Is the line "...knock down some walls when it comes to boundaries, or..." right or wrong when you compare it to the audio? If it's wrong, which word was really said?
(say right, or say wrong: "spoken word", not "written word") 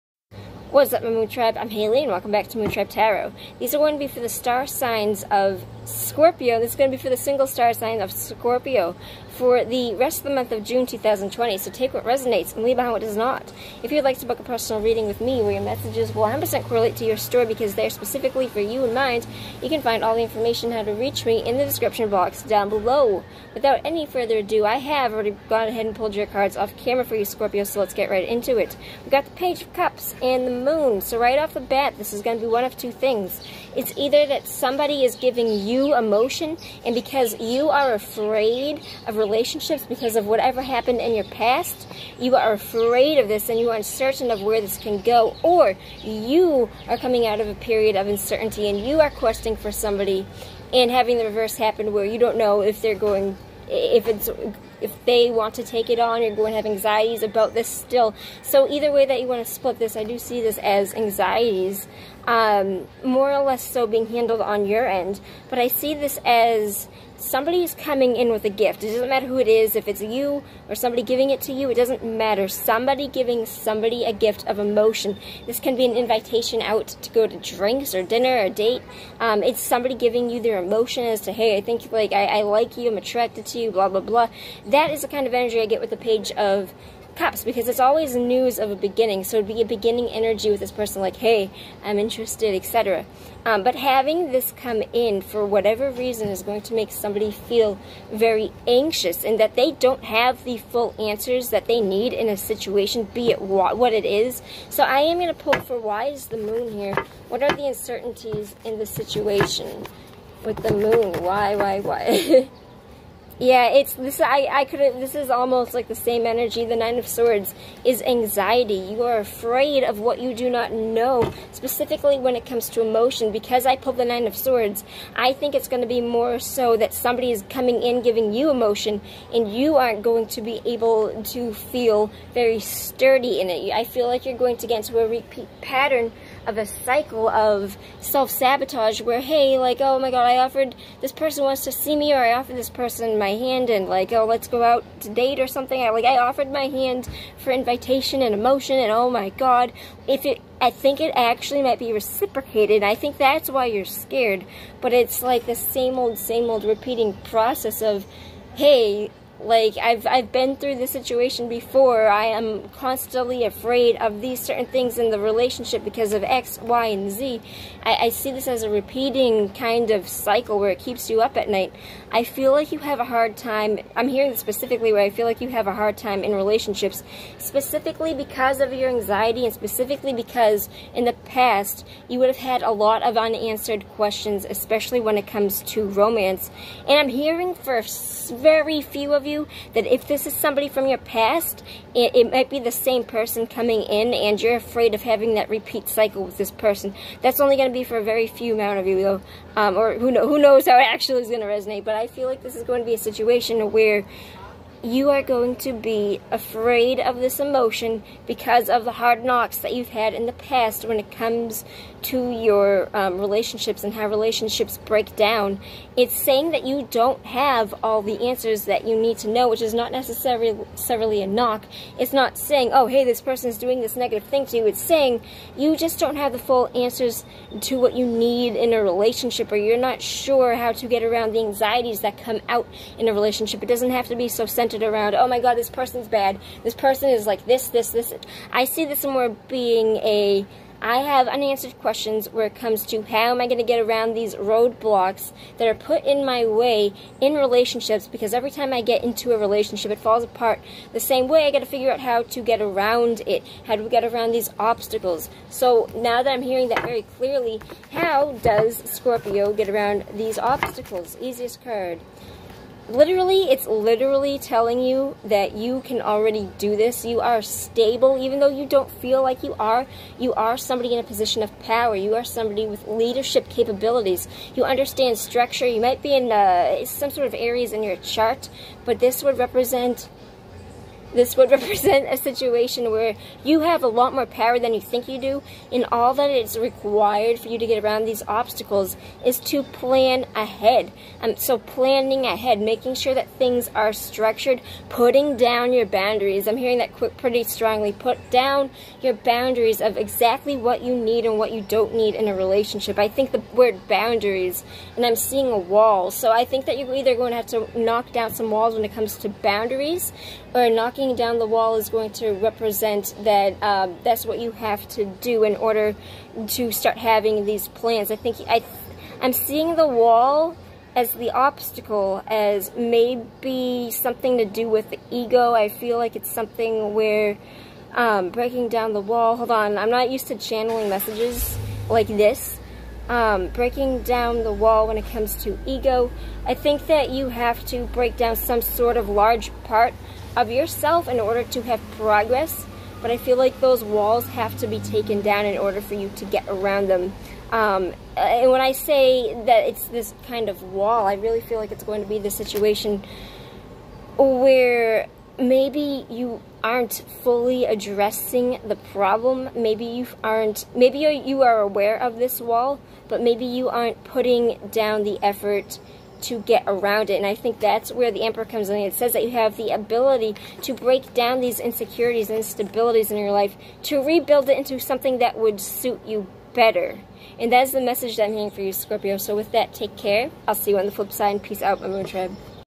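right.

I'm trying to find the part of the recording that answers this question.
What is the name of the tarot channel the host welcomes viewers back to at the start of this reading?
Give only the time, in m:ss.
0:02.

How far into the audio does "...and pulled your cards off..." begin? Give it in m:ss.
0:25.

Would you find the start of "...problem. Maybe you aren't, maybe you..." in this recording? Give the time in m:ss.
5:58.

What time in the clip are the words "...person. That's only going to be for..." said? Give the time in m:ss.
3:16.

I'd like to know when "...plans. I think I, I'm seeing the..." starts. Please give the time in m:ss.
5:17.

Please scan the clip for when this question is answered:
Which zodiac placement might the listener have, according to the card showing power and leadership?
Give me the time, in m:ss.
4:37.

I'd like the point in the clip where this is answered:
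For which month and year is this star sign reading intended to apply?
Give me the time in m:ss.
0:10.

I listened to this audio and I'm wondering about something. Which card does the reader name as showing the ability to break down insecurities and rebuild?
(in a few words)
The Emperor.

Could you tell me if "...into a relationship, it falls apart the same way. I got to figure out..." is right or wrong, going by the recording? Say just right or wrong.
right.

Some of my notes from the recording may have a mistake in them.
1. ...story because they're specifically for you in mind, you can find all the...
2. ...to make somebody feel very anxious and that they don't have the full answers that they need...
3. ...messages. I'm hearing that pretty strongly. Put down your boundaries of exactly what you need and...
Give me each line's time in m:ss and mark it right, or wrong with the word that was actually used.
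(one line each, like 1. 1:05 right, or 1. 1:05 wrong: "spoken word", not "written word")
1. 0:17 right
2. 1:36 right
3. 4:55 wrong: "boundaries", not "messages".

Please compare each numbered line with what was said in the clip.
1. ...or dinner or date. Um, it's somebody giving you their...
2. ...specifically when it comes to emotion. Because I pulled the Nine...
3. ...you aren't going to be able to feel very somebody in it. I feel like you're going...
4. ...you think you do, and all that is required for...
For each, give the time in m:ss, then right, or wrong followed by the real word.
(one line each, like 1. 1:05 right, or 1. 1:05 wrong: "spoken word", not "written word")
1. 1:17 right
2. 2:01 right
3. 2:09 wrong: "sturdy", not "somebody"
4. 4:44 right.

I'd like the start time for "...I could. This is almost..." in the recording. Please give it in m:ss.
1:54.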